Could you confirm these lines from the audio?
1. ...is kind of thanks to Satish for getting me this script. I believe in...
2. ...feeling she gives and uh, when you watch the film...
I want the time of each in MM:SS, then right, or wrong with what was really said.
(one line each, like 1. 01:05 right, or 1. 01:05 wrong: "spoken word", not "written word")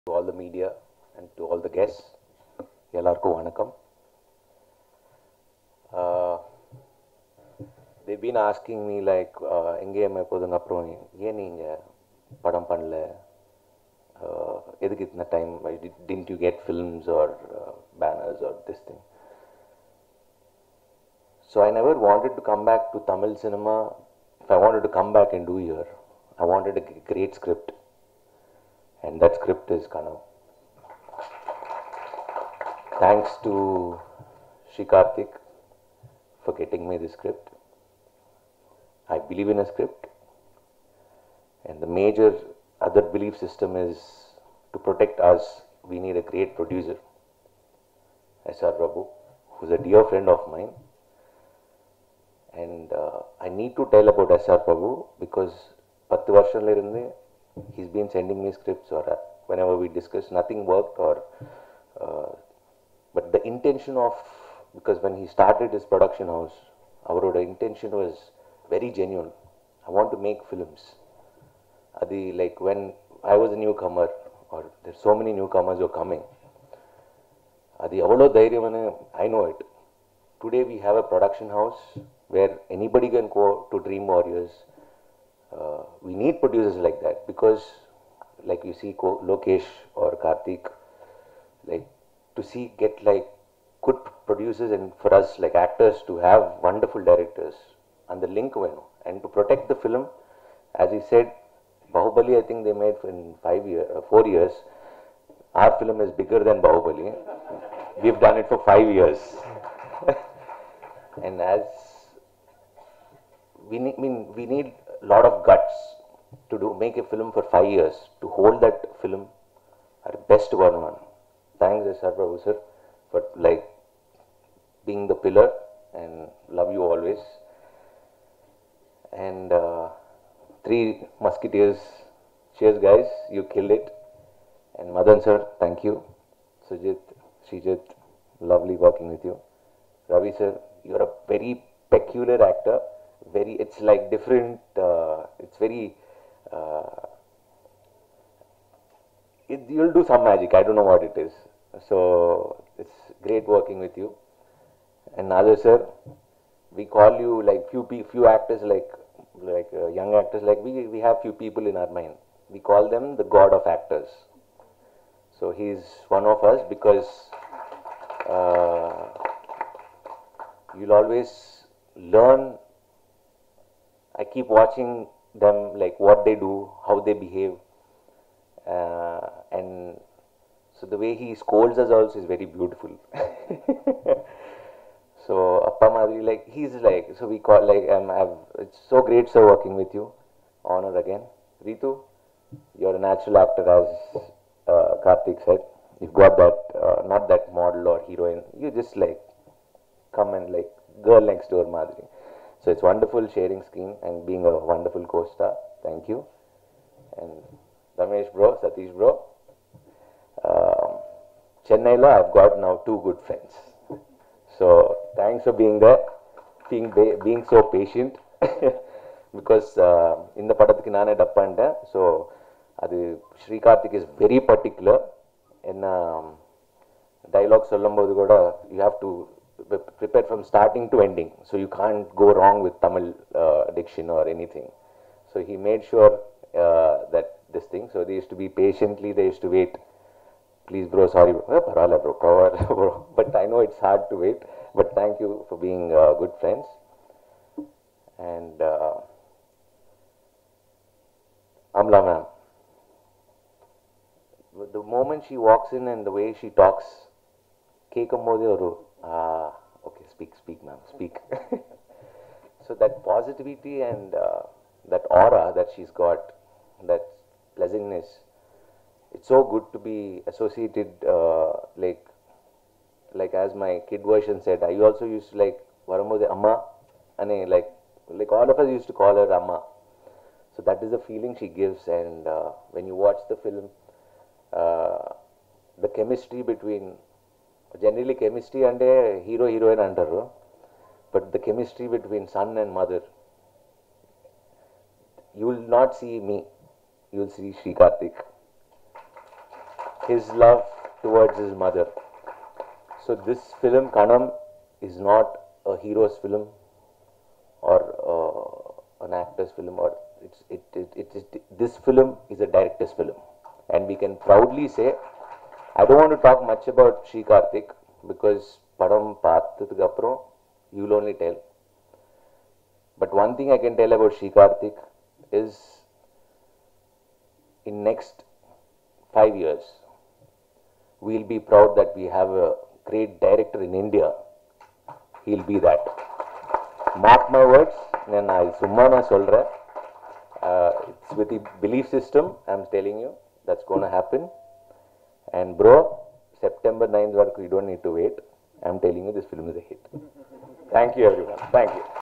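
1. 00:29 wrong: "Srikarthik", not "Satish"
2. 04:41 right.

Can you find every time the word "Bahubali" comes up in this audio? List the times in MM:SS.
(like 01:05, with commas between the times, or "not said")
01:41, 01:46.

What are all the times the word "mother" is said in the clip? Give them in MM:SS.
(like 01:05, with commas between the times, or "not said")
04:52, 05:01.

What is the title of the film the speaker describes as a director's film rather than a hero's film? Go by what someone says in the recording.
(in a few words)
Kanam.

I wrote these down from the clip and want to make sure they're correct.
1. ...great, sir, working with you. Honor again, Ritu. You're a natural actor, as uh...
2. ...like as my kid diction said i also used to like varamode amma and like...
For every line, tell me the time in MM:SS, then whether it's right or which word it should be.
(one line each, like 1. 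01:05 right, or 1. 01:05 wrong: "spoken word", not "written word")
1. 03:09 right
2. 04:33 wrong: "version", not "diction".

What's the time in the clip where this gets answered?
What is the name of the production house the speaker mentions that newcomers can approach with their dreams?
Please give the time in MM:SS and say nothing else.
01:23.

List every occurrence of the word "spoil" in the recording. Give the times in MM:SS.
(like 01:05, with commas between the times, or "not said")
not said.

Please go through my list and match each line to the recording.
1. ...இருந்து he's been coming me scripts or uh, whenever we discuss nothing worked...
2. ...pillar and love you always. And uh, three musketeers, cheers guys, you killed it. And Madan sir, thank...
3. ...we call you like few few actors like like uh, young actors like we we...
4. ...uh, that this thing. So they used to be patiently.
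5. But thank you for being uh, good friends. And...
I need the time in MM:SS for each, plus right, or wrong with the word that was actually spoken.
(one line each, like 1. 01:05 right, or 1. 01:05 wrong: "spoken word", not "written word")
1. 00:56 wrong: "sending", not "coming"
2. 02:05 right
3. 02:36 right
4. 03:56 right
5. 04:04 right.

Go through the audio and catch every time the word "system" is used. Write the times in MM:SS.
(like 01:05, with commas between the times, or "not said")
00:43, 05:41.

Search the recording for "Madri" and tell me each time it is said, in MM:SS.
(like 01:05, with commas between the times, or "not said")
03:05, 03:21.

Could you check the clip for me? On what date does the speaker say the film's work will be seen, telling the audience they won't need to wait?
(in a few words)
September 9.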